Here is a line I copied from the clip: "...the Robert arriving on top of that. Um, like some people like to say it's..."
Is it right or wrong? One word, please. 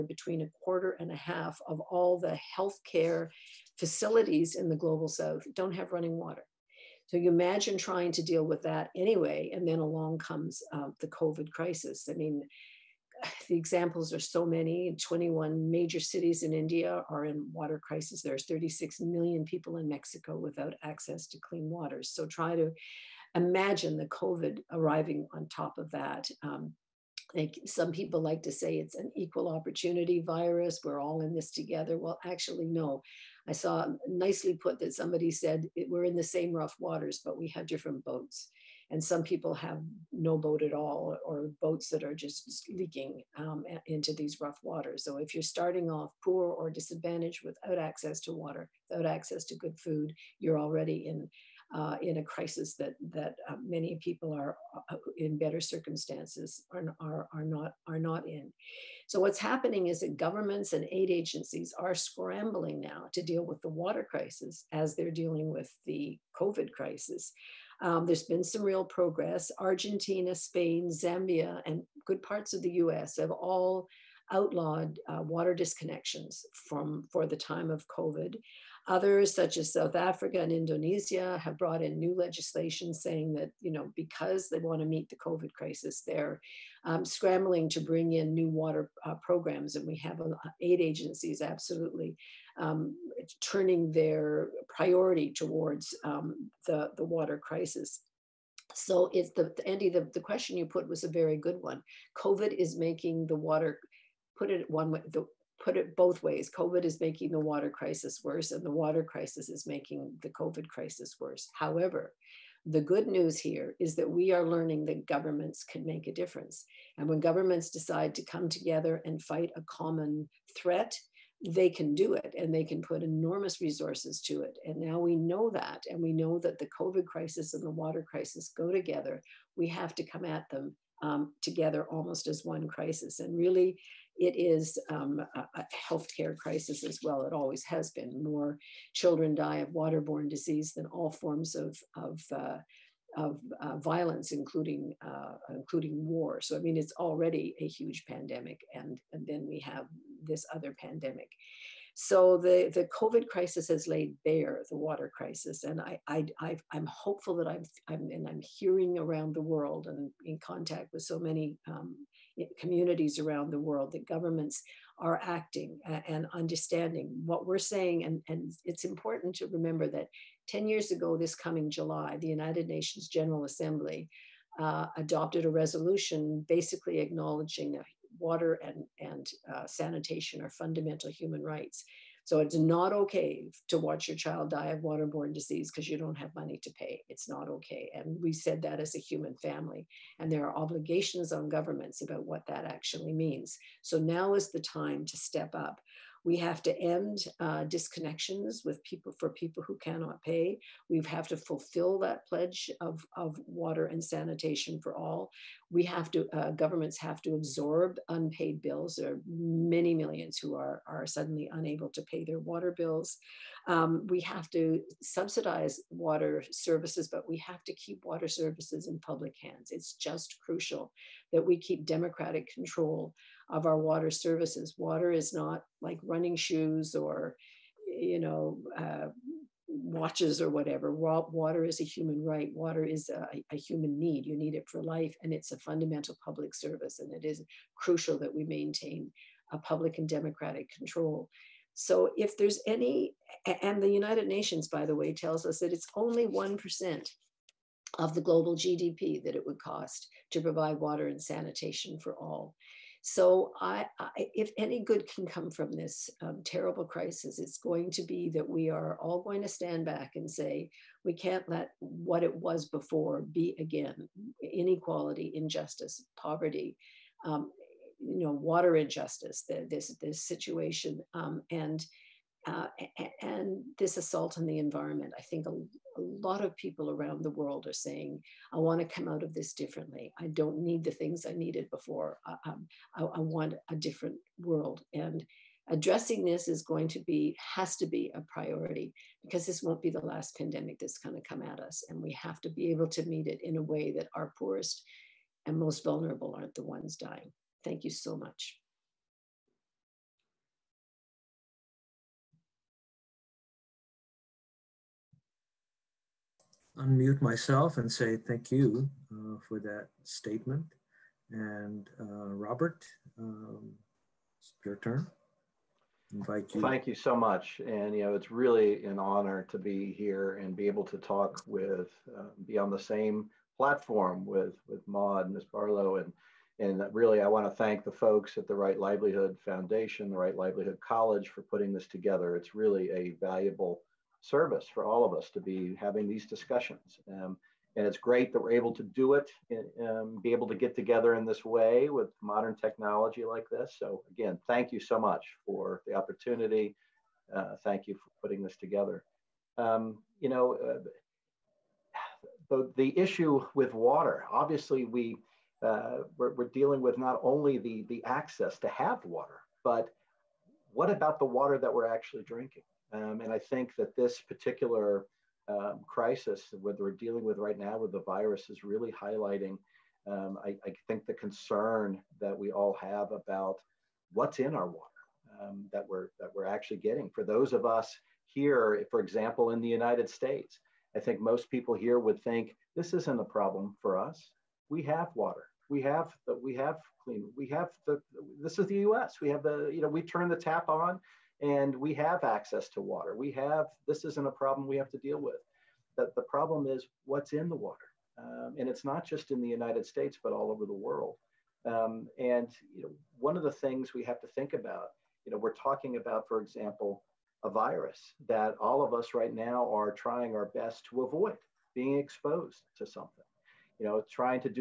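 wrong.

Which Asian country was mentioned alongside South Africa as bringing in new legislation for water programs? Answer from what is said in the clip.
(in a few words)
Indonesia.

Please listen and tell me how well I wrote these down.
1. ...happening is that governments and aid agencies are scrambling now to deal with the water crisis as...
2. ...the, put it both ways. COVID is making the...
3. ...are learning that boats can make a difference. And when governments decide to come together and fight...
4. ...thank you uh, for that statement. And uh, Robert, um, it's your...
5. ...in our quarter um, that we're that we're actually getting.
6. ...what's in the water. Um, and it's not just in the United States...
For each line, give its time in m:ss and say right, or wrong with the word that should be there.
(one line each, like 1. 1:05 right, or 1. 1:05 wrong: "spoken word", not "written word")
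1. 0:59 right
2. 1:45 right
3. 1:54 wrong: "governments", not "boats"
4. 5:08 right
5. 6:14 wrong: "water", not "quarter"
6. 6:37 right.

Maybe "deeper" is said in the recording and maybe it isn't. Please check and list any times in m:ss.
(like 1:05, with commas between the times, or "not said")
not said.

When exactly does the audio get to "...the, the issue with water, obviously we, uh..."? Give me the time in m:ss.
5:52.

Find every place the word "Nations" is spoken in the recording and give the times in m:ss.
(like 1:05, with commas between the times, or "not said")
2:52, 4:04.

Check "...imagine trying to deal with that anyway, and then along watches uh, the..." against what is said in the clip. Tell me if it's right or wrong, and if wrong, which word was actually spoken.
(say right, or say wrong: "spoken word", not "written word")
wrong: "comes", not "watches".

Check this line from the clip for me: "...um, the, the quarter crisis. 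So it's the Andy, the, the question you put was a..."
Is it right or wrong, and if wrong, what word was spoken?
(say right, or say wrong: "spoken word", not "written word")
wrong: "water", not "quarter".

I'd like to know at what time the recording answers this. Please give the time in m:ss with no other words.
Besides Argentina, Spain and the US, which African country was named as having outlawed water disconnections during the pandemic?
1:10.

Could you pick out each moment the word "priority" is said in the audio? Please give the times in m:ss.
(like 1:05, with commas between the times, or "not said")
1:34, 4:48.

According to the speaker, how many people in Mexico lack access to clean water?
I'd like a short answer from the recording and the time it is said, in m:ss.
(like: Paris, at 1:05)
36 million, at 0:18.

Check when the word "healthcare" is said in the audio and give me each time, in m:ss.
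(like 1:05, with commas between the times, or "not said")
0:02, 2:15.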